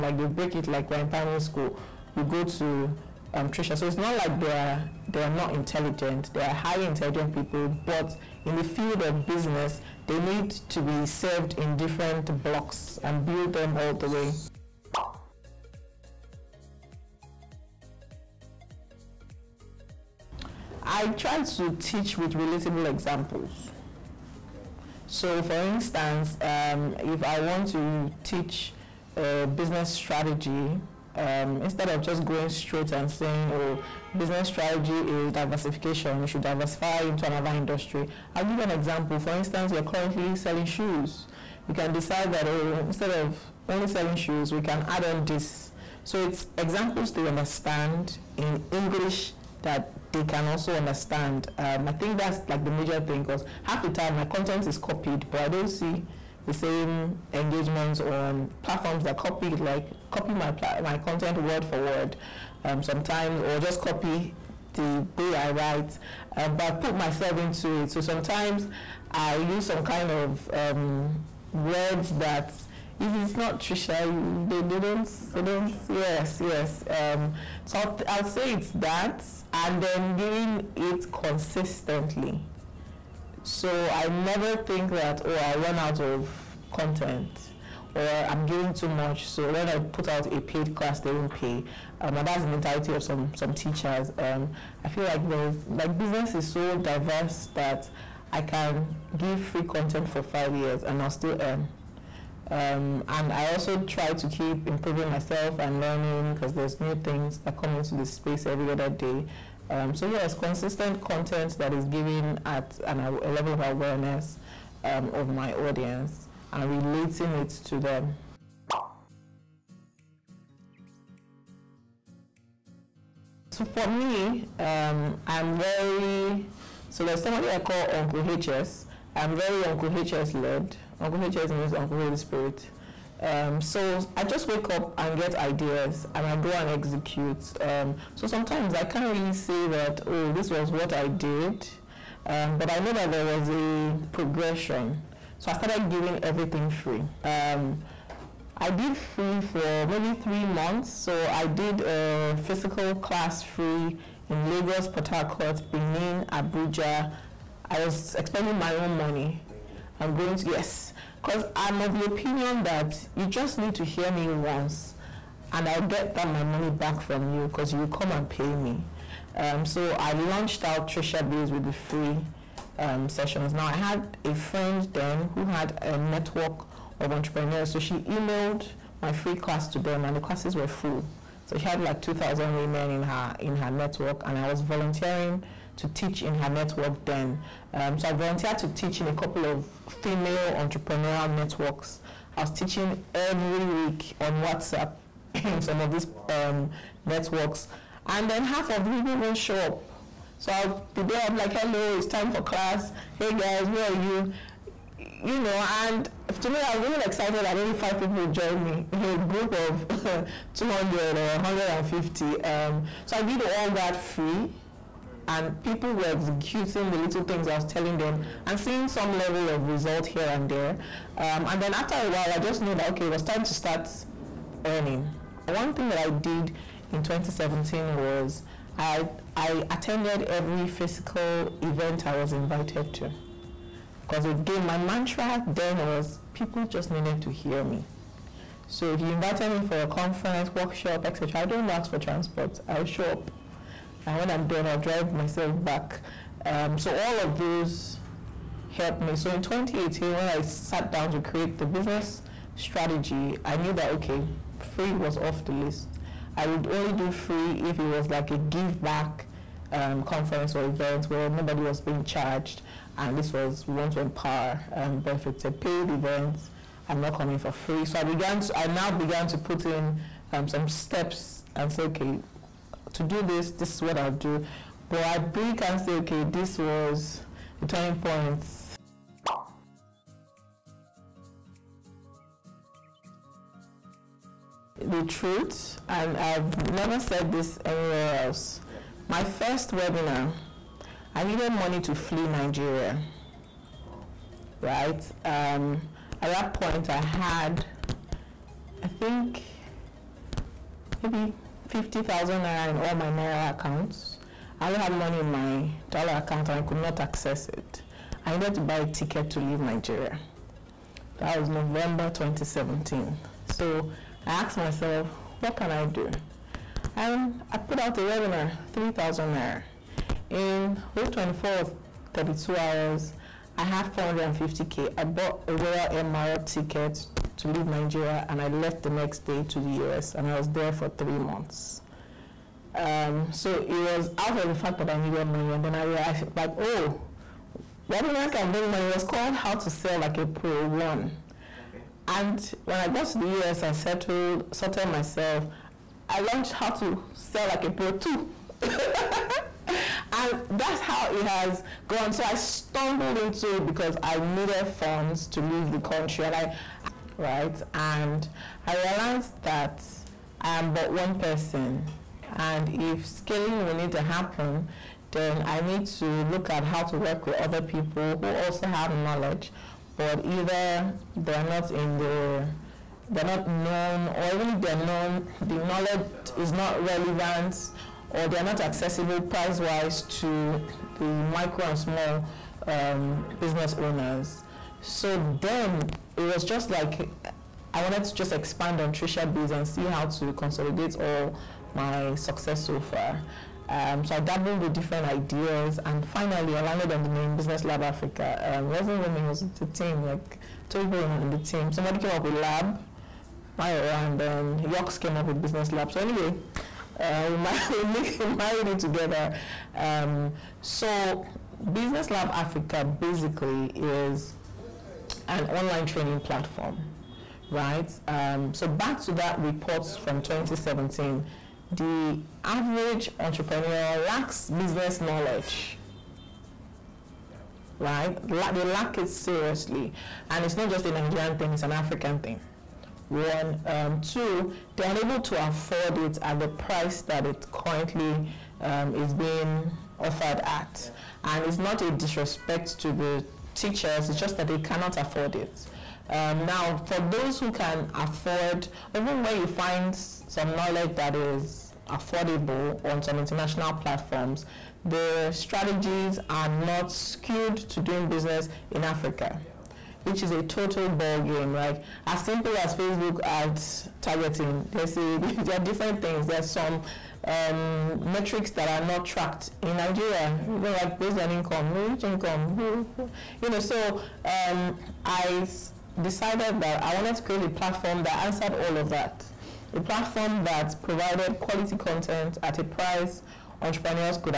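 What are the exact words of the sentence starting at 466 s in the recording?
There's some um, metrics that are not tracked in Nigeria.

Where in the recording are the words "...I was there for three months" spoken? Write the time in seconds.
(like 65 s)
330 s.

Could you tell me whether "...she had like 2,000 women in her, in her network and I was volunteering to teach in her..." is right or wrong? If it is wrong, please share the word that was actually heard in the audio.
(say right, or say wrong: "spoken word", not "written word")
right.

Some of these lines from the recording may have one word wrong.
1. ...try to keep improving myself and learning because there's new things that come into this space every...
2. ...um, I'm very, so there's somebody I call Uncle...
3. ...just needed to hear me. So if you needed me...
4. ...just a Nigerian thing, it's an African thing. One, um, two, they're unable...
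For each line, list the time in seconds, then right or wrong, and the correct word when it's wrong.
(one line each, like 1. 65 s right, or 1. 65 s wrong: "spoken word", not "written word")
1. 103 s right
2. 124 s right
3. 236 s wrong: "invited", not "needed"
4. 430 s right.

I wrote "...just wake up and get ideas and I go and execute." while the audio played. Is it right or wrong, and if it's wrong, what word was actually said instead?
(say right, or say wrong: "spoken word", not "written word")
right.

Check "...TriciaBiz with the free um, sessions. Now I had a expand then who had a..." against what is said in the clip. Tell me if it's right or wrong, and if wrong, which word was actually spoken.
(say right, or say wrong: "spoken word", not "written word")
wrong: "friend", not "expand".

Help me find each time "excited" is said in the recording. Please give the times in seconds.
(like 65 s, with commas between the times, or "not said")
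207 s.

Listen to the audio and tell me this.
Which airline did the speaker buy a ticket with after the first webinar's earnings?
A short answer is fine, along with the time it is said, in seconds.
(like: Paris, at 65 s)
Royal Maroc, at 325 s.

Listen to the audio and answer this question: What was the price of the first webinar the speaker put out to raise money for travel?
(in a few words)
3,000 naira.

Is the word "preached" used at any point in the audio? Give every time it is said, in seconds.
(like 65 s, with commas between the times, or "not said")
not said.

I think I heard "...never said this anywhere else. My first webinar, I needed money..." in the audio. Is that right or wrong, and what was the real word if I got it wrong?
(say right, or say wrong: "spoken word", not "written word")
right.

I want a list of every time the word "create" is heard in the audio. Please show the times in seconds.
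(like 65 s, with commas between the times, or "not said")
251 s, 477 s.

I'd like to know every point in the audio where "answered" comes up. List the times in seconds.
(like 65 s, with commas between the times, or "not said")
478 s.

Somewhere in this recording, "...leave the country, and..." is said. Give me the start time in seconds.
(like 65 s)
355 s.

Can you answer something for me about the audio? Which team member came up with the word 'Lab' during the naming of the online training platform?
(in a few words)
Mayowa.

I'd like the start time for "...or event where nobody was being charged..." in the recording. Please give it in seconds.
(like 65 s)
260 s.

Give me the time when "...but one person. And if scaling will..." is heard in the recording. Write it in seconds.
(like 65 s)
360 s.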